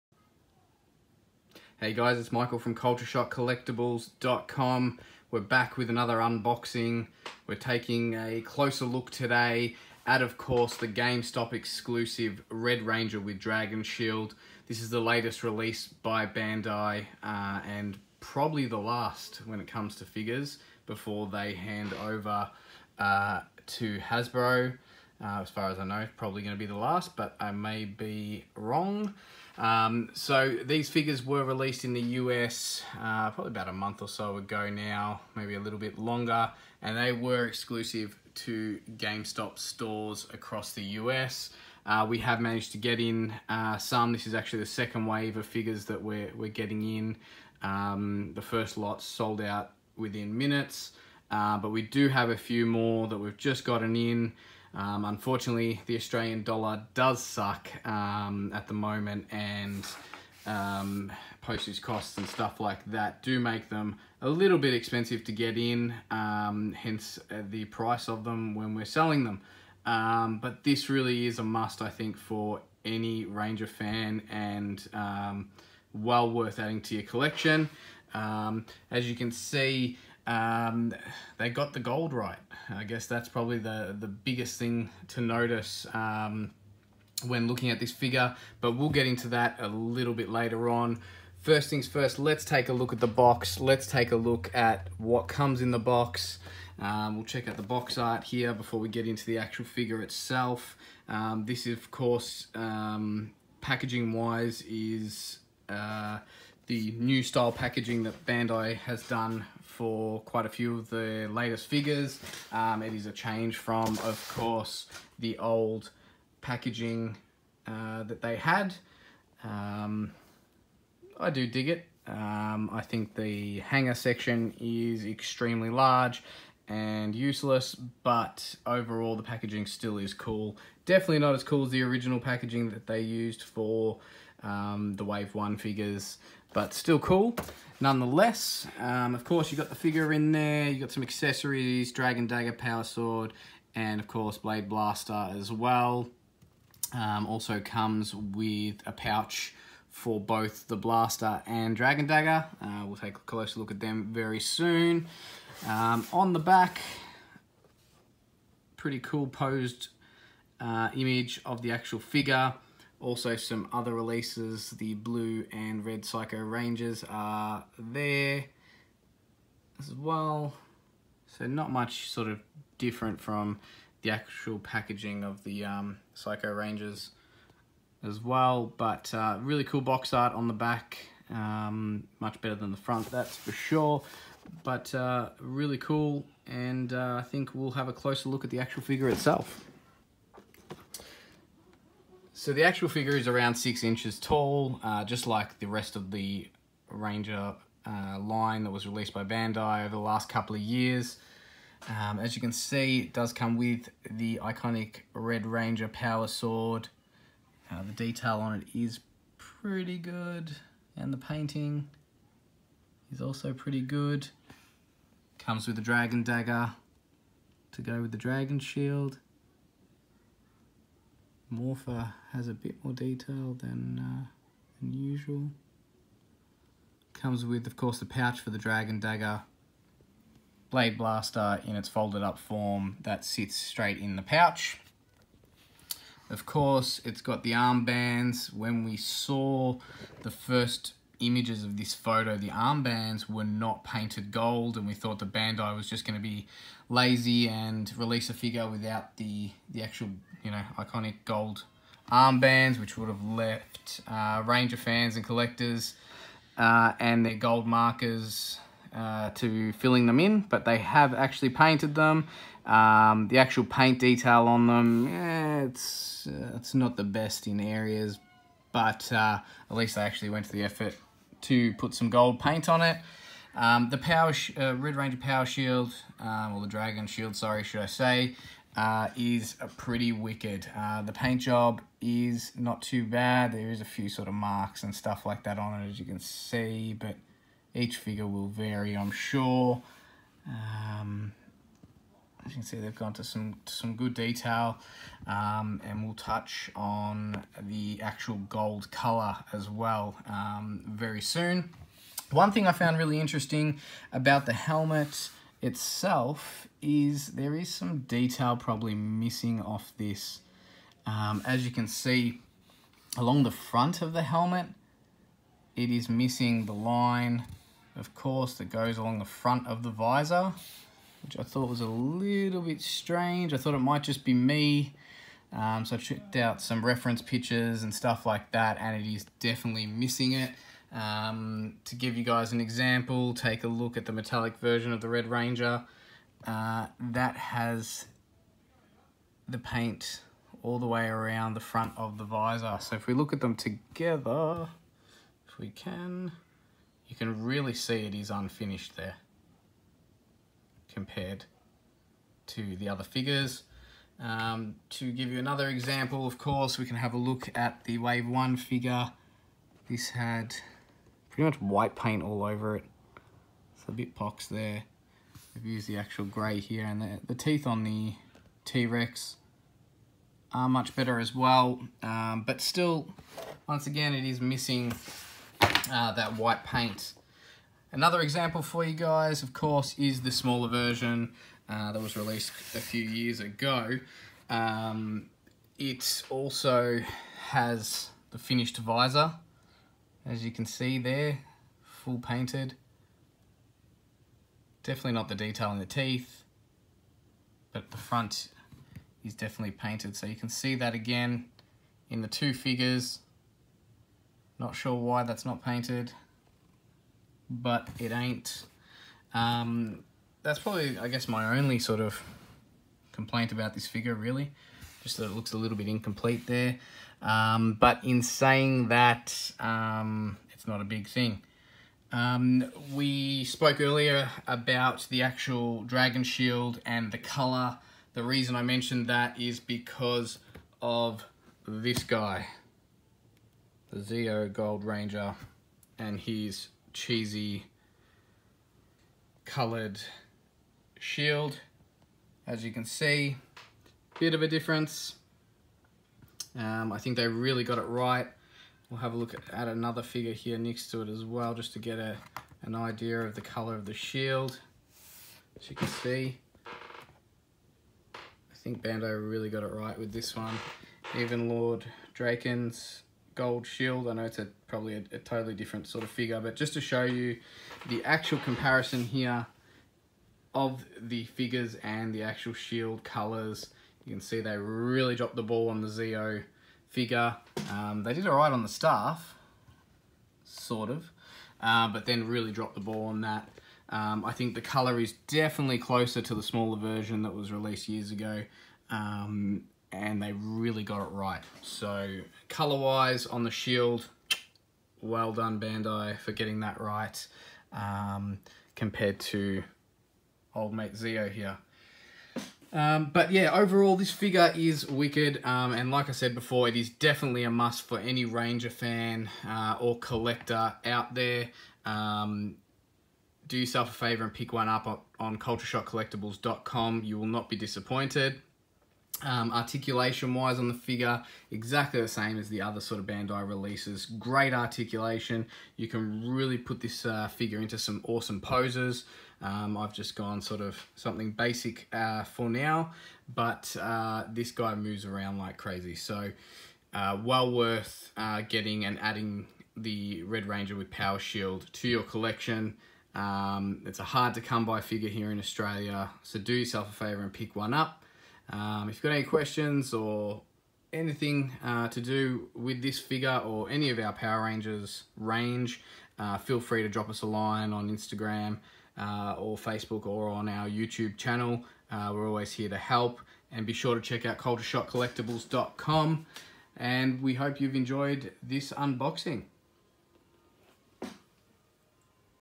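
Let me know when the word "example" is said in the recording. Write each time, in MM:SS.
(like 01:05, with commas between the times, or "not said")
05:32, 05:55, 06:18.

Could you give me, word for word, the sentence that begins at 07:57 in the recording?
Um, they did all right on the staff, sort of, uh, but then really dropped the ball on that.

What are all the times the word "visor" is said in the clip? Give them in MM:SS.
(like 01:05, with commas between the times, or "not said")
05:19, 05:42, 06:28.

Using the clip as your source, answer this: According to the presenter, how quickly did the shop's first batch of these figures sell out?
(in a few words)
Within minutes.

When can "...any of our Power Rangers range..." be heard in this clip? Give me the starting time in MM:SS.
09:13.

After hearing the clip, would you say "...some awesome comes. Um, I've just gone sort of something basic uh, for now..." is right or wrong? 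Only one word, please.
wrong.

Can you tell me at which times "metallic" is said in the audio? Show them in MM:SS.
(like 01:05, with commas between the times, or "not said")
05:34.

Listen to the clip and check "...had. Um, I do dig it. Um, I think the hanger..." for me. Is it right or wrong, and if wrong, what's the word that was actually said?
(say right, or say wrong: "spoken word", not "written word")
right.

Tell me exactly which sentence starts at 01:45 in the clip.
Uh, the new style packaging that Bandai has done for quite a few of the latest figures.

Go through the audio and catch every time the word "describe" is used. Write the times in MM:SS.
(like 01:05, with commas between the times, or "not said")
not said.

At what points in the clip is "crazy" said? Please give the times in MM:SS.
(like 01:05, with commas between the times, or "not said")
08:55.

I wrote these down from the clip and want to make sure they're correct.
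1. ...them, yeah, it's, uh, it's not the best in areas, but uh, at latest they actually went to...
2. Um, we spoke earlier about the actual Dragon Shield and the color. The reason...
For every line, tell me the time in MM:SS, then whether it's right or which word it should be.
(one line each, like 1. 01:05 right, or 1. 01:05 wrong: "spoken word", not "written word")
1. 04:24 wrong: "least", not "latest"
2. 07:02 right.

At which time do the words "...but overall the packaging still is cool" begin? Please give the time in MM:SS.
02:07.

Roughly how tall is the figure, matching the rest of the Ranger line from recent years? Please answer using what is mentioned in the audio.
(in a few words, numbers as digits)
6 inches.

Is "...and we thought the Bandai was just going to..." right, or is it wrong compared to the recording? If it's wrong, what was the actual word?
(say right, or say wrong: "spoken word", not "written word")
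right.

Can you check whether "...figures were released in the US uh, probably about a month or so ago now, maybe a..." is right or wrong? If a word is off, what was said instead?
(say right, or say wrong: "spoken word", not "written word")
right.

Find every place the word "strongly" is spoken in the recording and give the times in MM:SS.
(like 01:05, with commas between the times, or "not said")
not said.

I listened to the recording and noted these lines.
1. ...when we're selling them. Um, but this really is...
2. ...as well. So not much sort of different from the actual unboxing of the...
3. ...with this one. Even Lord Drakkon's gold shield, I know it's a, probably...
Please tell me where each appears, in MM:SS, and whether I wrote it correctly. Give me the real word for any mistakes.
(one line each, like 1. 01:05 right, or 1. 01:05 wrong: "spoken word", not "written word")
1. 01:08 right
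2. 02:49 wrong: "packaging", not "unboxing"
3. 07:39 right.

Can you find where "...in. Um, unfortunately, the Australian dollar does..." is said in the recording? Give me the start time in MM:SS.
00:53.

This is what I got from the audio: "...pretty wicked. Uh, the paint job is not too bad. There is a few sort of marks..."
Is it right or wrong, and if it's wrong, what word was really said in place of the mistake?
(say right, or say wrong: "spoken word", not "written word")
right.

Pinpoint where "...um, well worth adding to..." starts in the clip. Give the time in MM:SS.
01:14.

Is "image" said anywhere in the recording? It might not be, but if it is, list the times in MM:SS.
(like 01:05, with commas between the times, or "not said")
02:40, 04:01.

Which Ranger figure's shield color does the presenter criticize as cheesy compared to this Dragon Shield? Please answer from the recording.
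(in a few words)
Zeo Gold Ranger.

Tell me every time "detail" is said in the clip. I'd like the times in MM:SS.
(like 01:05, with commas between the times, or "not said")
03:27, 03:42, 04:23, 04:54, 05:08, 06:35.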